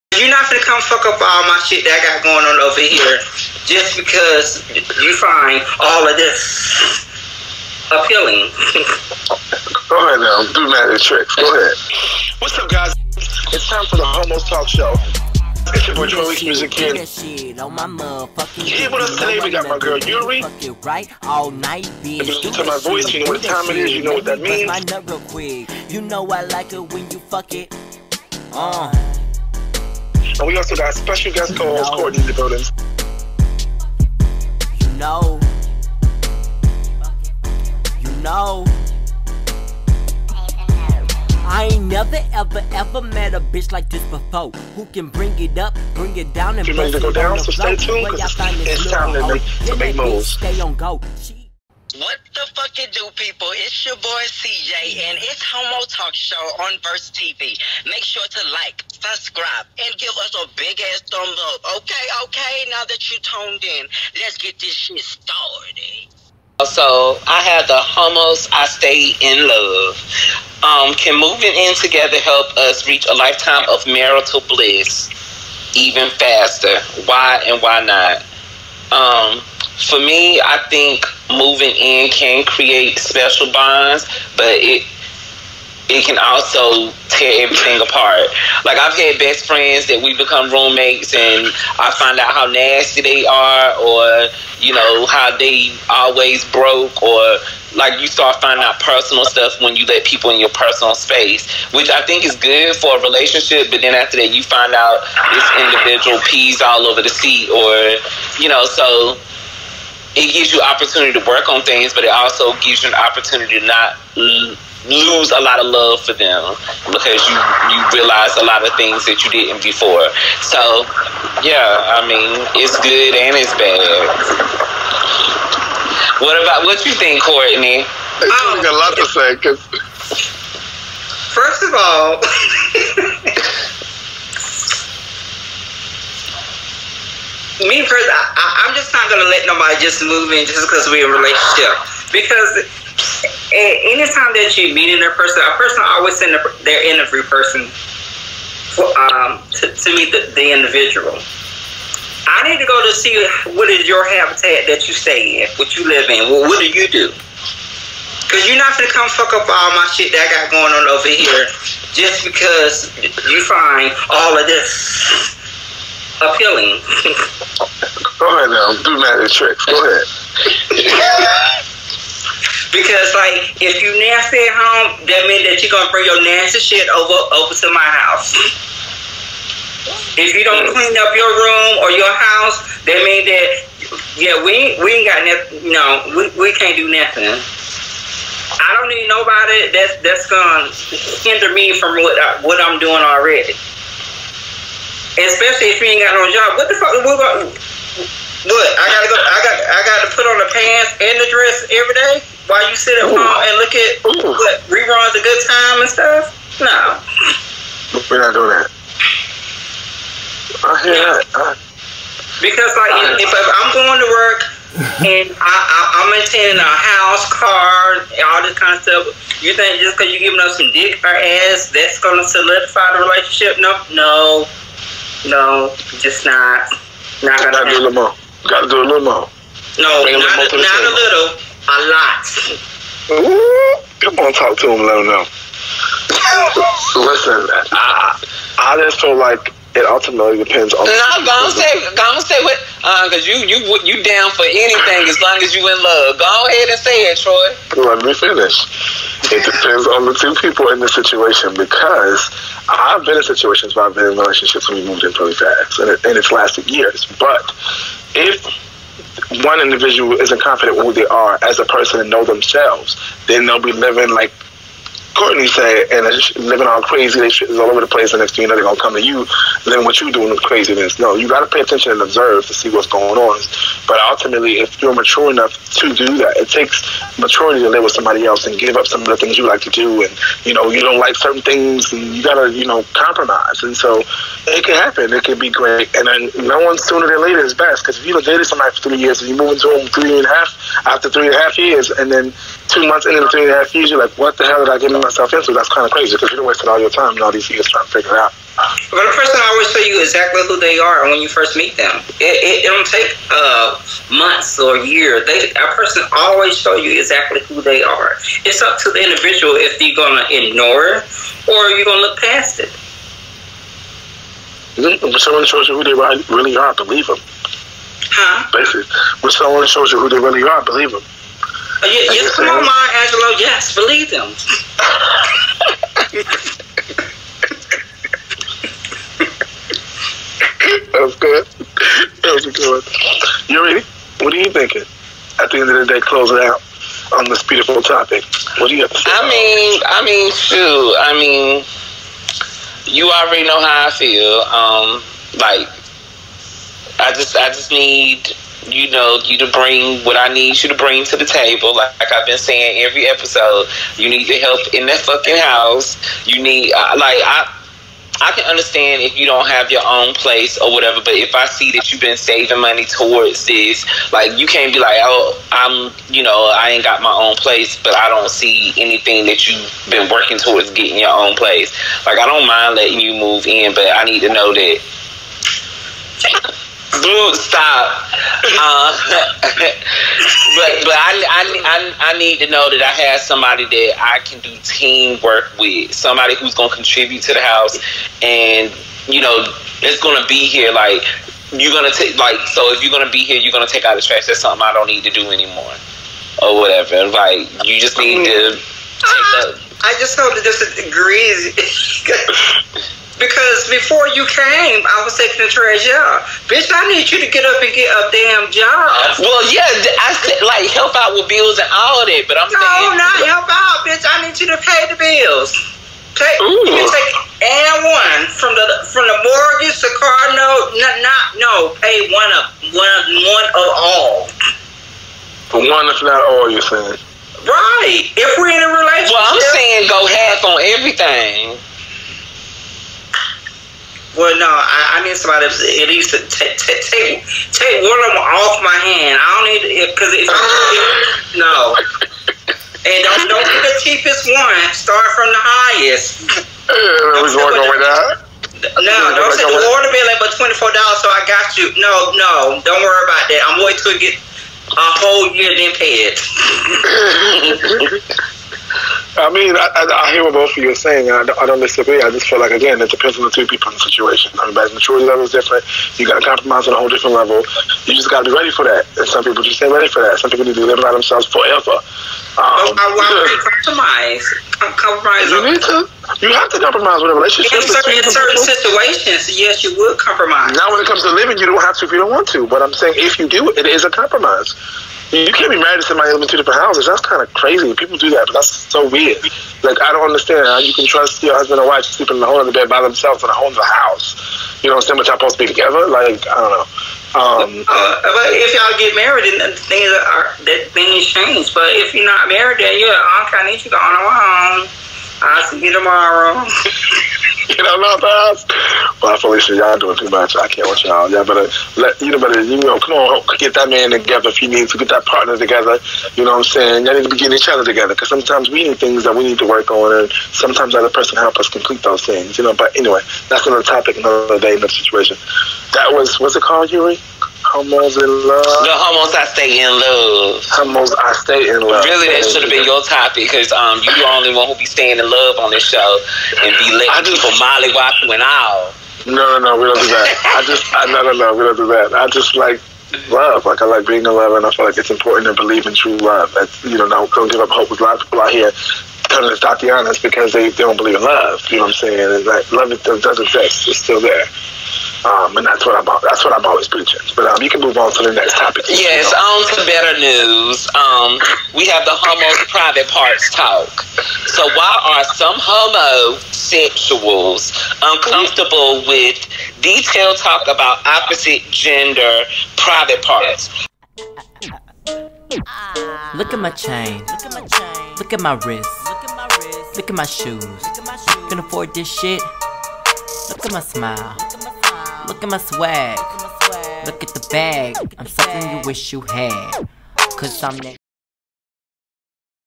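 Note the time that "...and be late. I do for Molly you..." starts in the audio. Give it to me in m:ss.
8:56.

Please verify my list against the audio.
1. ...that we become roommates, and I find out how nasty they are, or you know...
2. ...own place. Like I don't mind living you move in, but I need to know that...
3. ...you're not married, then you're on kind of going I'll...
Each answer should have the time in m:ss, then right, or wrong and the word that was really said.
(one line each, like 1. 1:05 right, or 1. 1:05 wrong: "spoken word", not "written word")
1. 1:29 right
2. 6:11 wrong: "letting", not "living"
3. 8:21 right.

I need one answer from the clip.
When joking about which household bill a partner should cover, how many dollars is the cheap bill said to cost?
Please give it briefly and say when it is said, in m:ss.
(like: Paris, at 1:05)
24, at 7:30.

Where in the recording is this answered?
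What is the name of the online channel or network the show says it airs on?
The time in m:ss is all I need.
0:56.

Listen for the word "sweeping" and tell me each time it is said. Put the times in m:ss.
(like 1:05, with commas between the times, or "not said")
not said.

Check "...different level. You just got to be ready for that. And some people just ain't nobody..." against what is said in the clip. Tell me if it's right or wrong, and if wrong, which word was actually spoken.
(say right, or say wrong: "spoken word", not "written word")
wrong: "ready", not "nobody".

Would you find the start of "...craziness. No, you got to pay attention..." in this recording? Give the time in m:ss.
4:30.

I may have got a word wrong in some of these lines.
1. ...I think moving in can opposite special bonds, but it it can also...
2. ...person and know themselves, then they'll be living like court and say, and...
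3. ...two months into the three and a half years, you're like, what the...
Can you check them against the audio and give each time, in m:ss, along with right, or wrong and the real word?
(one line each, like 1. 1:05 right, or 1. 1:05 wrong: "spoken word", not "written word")
1. 1:20 wrong: "create", not "opposite"
2. 4:21 right
3. 4:52 right.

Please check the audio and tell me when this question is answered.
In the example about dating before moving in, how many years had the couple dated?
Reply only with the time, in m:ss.
4:48.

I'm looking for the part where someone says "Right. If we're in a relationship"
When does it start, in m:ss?
7:07.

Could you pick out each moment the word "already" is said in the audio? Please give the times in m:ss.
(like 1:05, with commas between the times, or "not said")
3:13, 5:43.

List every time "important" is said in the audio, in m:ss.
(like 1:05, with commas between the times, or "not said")
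9:04.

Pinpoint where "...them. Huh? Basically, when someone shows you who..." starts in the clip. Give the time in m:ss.
5:17.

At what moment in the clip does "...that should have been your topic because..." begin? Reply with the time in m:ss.
8:52.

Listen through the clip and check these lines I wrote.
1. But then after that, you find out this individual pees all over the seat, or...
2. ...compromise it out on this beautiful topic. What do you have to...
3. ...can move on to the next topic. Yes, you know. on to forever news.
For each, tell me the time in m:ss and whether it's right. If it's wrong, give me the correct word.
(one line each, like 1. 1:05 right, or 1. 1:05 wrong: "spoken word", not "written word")
1. 1:43 right
2. 5:36 wrong: "close", not "compromise"
3. 9:17 wrong: "better", not "forever".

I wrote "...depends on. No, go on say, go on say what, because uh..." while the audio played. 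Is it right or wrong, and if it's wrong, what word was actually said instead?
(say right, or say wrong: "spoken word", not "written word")
right.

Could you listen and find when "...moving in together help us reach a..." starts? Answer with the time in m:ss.
1:11.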